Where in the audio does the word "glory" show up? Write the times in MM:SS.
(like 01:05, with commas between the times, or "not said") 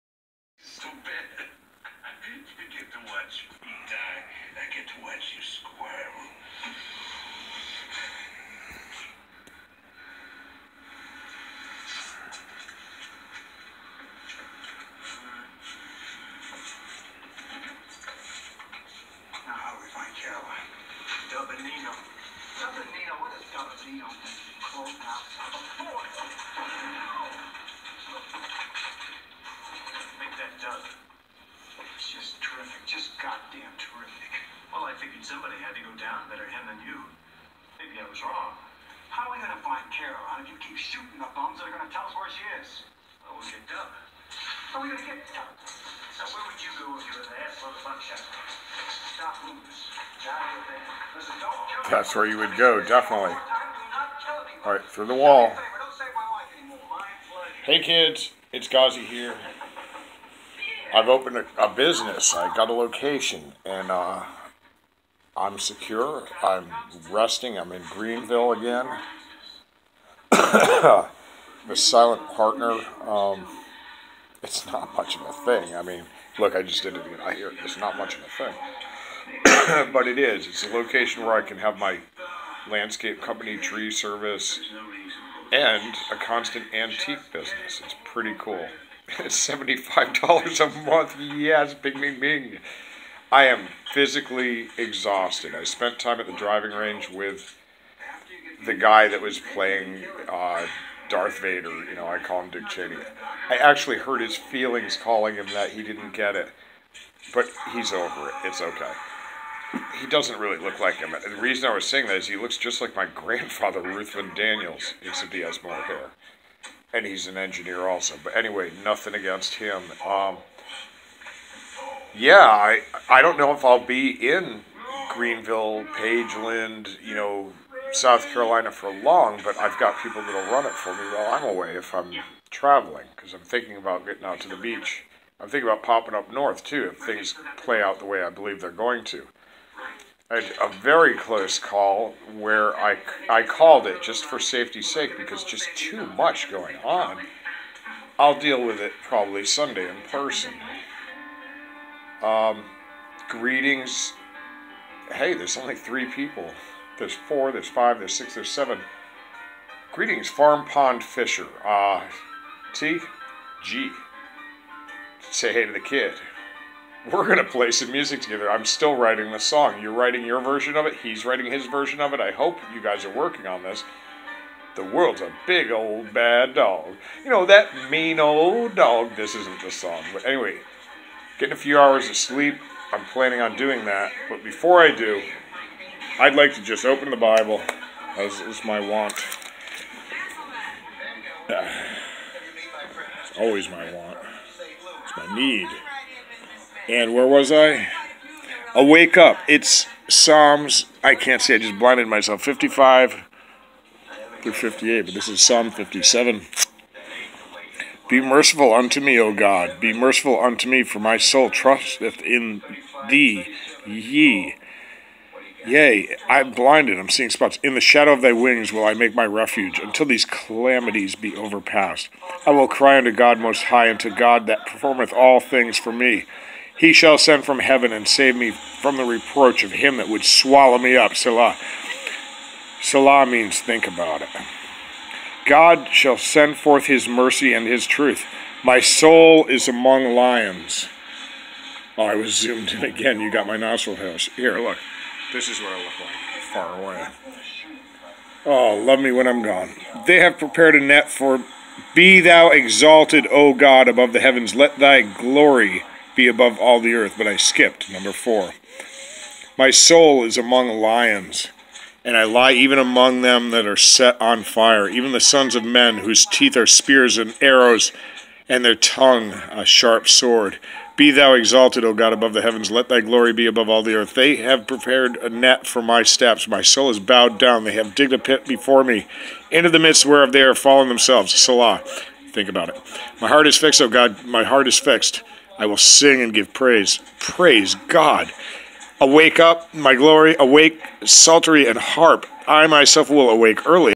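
04:15, 04:33, 04:49.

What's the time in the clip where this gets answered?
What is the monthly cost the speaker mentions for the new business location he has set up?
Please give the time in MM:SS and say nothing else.
01:29.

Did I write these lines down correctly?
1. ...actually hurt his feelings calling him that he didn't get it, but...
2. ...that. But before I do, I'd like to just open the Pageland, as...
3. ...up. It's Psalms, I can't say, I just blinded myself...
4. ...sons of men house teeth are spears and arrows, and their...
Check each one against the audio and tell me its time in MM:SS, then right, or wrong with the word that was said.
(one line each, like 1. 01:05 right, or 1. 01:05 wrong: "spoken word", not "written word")
1. 01:43 right
2. 03:03 wrong: "Bible", not "Pageland"
3. 03:19 right
4. 04:25 wrong: "whose", not "house".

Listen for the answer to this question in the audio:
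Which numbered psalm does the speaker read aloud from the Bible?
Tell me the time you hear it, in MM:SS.
03:25.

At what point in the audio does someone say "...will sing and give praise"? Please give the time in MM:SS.
04:45.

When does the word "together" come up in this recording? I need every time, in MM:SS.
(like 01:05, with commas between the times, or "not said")
02:48.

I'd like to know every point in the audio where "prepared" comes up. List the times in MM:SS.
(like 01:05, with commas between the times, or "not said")
04:10, 04:34.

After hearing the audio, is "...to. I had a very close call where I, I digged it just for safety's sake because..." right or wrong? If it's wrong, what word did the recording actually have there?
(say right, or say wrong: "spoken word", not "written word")
wrong: "called", not "digged".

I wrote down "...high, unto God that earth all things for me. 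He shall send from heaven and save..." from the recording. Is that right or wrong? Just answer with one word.
wrong.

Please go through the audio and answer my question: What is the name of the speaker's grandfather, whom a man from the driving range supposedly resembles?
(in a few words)
Ruthven Daniels.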